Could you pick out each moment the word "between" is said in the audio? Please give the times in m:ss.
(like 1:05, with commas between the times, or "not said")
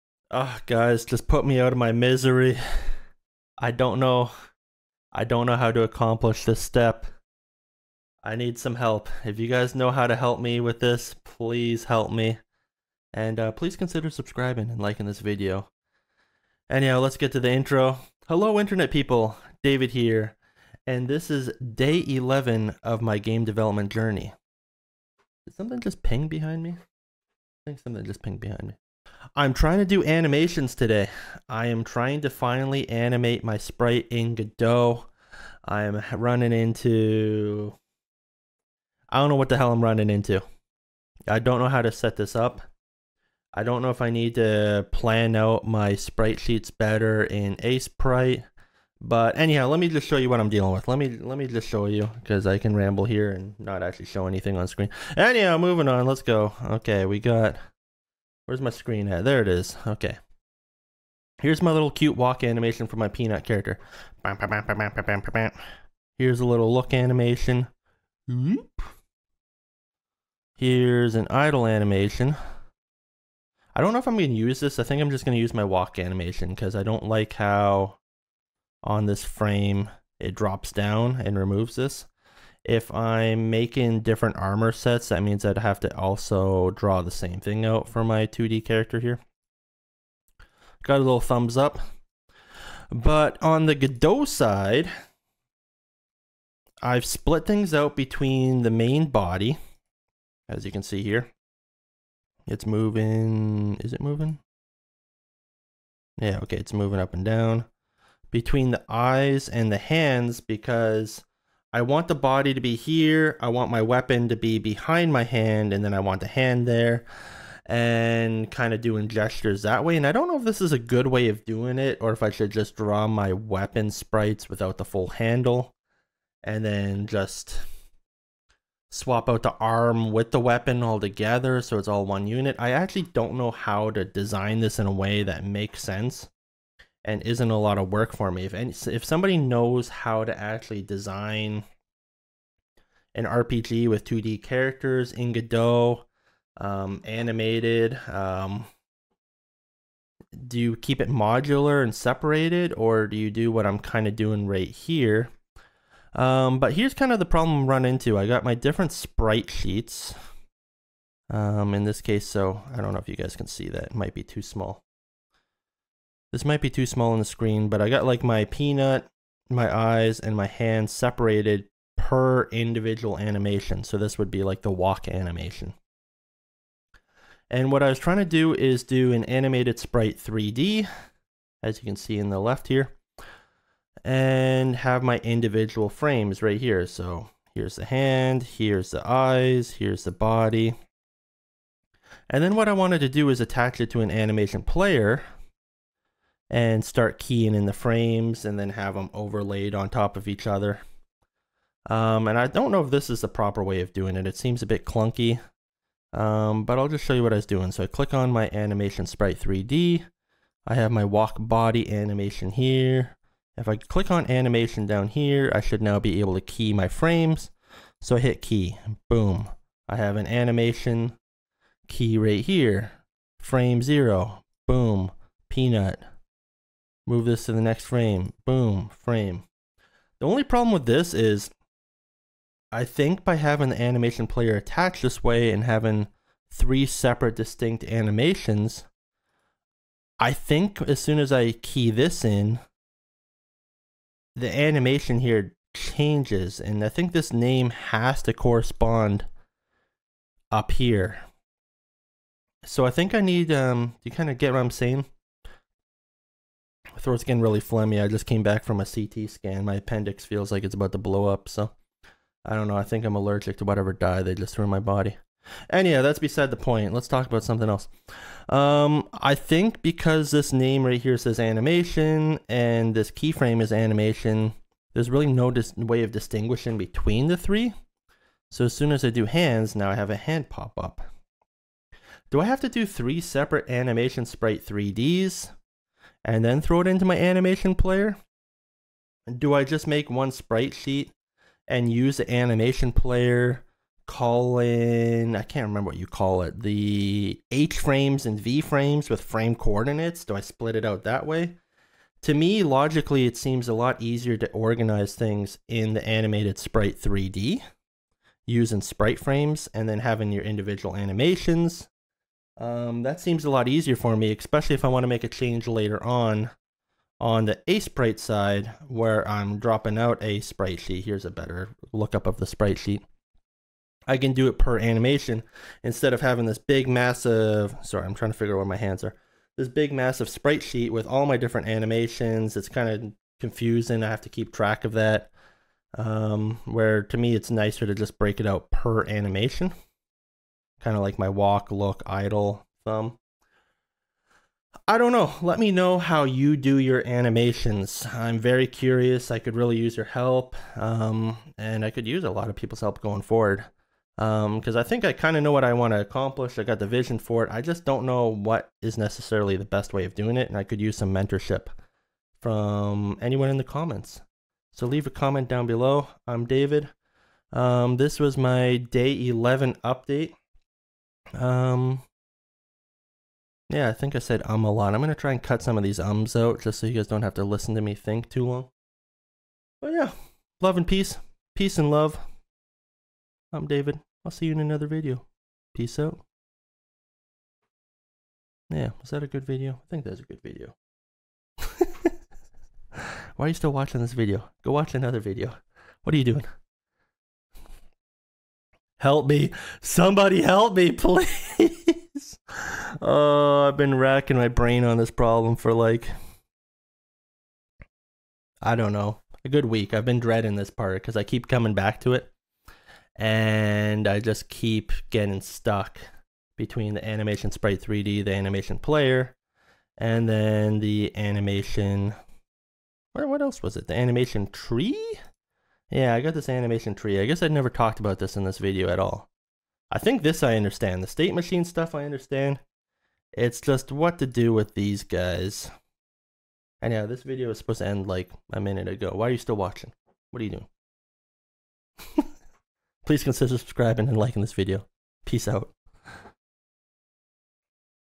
1:37, 1:48, 4:36, 6:56.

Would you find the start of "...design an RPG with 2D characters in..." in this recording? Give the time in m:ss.
2:20.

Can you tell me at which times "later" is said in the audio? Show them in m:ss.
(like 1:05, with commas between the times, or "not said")
5:15.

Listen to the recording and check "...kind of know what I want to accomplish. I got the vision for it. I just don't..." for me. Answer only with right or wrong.
right.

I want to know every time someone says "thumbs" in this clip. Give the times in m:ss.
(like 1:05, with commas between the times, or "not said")
1:31, 5:42.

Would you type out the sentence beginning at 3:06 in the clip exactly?
So here's the hand, here's the eyes, here's the body.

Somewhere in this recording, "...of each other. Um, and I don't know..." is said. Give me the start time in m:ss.
3:20.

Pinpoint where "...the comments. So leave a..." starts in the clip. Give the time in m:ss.
6:03.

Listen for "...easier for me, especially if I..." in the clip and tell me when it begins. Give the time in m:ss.
5:13.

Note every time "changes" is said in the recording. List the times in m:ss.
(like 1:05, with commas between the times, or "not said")
4:05, 5:15.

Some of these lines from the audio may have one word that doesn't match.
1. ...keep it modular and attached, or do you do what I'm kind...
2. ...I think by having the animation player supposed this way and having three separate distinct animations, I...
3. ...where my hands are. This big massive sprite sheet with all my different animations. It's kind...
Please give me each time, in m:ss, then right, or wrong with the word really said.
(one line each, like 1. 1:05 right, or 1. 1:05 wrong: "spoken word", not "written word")
1. 2:30 wrong: "separated", not "attached"
2. 3:52 wrong: "attached", not "supposed"
3. 5:28 right.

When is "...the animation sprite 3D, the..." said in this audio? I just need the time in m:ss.
6:56.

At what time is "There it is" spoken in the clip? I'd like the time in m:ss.
0:59.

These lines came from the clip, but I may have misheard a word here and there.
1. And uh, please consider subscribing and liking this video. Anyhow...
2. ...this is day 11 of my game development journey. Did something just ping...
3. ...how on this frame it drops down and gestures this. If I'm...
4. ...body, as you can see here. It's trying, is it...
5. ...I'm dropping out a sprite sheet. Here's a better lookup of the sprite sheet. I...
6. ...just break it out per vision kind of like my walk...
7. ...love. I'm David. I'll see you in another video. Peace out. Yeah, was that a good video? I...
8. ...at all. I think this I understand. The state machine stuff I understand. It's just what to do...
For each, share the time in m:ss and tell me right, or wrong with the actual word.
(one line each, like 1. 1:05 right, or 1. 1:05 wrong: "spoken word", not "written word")
1. 0:13 right
2. 0:21 right
3. 1:17 wrong: "removes", not "gestures"
4. 1:39 wrong: "moving", not "trying"
5. 5:19 right
6. 5:37 wrong: "animation", not "vision"
7. 6:21 right
8. 7:08 right.